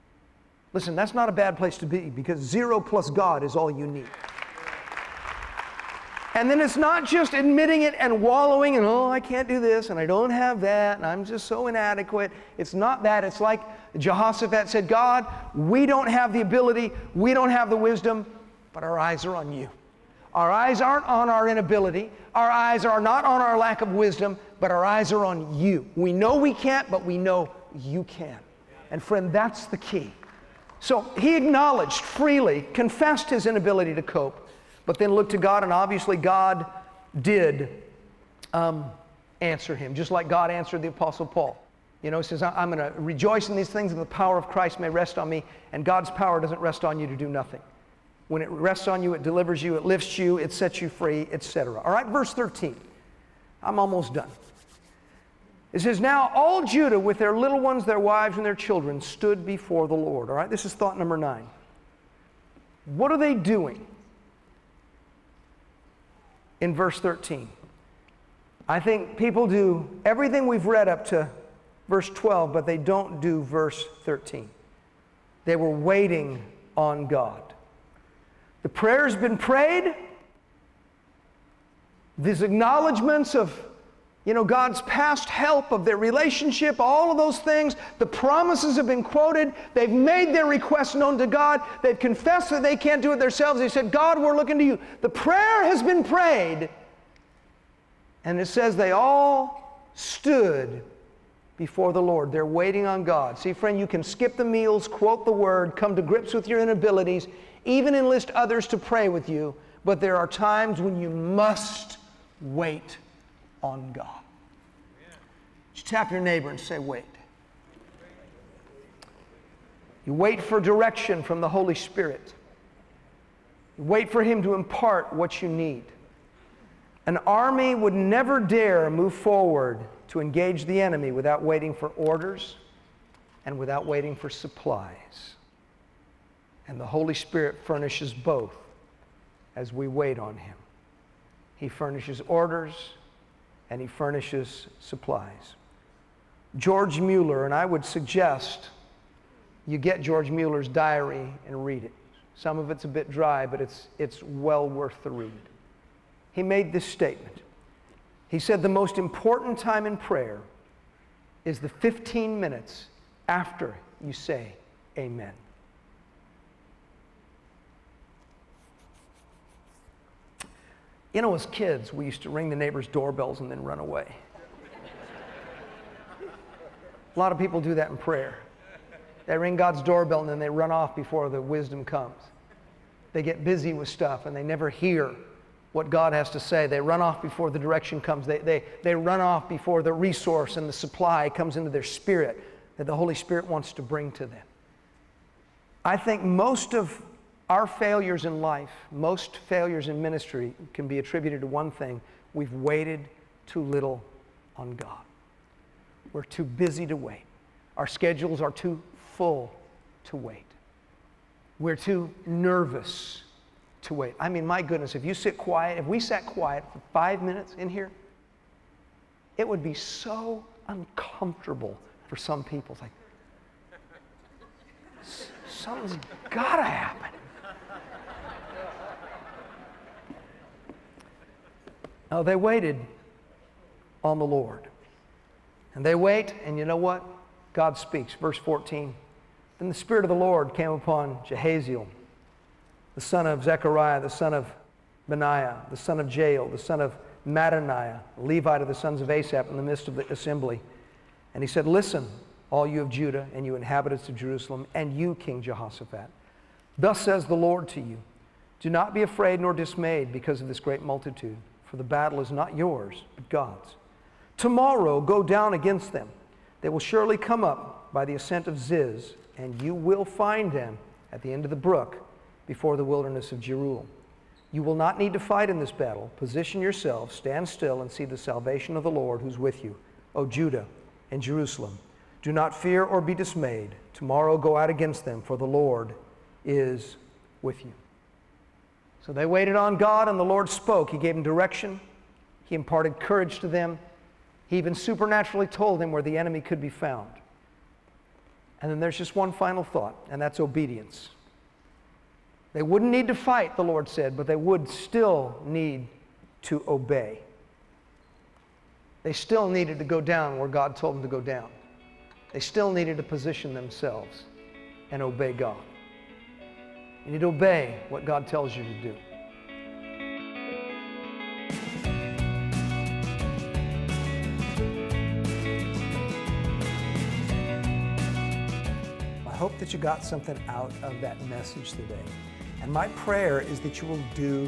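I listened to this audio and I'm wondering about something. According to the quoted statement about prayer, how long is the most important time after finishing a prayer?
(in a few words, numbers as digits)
15 minutes.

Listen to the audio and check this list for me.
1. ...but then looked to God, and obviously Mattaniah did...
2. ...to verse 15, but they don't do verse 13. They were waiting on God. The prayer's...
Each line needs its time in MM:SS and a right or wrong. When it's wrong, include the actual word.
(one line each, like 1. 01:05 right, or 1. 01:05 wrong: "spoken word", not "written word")
1. 00:34 wrong: "God", not "Mattaniah"
2. 01:11 wrong: "12", not "15".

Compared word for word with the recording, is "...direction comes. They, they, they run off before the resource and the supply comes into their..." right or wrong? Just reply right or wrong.
right.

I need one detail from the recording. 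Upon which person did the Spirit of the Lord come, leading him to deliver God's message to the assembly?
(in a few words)
Jehaziel.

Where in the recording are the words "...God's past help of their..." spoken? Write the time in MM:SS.
01:24.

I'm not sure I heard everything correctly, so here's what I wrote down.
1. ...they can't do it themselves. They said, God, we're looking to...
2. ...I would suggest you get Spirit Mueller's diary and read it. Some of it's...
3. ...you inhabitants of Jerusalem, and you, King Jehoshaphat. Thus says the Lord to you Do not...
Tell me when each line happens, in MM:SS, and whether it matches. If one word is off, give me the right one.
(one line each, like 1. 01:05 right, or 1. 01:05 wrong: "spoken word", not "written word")
1. 01:32 right
2. 02:27 wrong: "George", not "Spirit"
3. 04:13 right.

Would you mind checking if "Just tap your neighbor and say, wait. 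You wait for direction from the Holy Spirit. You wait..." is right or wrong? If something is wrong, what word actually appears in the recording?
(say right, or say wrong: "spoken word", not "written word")
right.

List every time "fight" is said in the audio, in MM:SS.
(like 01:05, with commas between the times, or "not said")
04:35, 05:03.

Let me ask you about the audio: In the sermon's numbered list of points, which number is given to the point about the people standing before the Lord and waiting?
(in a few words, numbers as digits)
9.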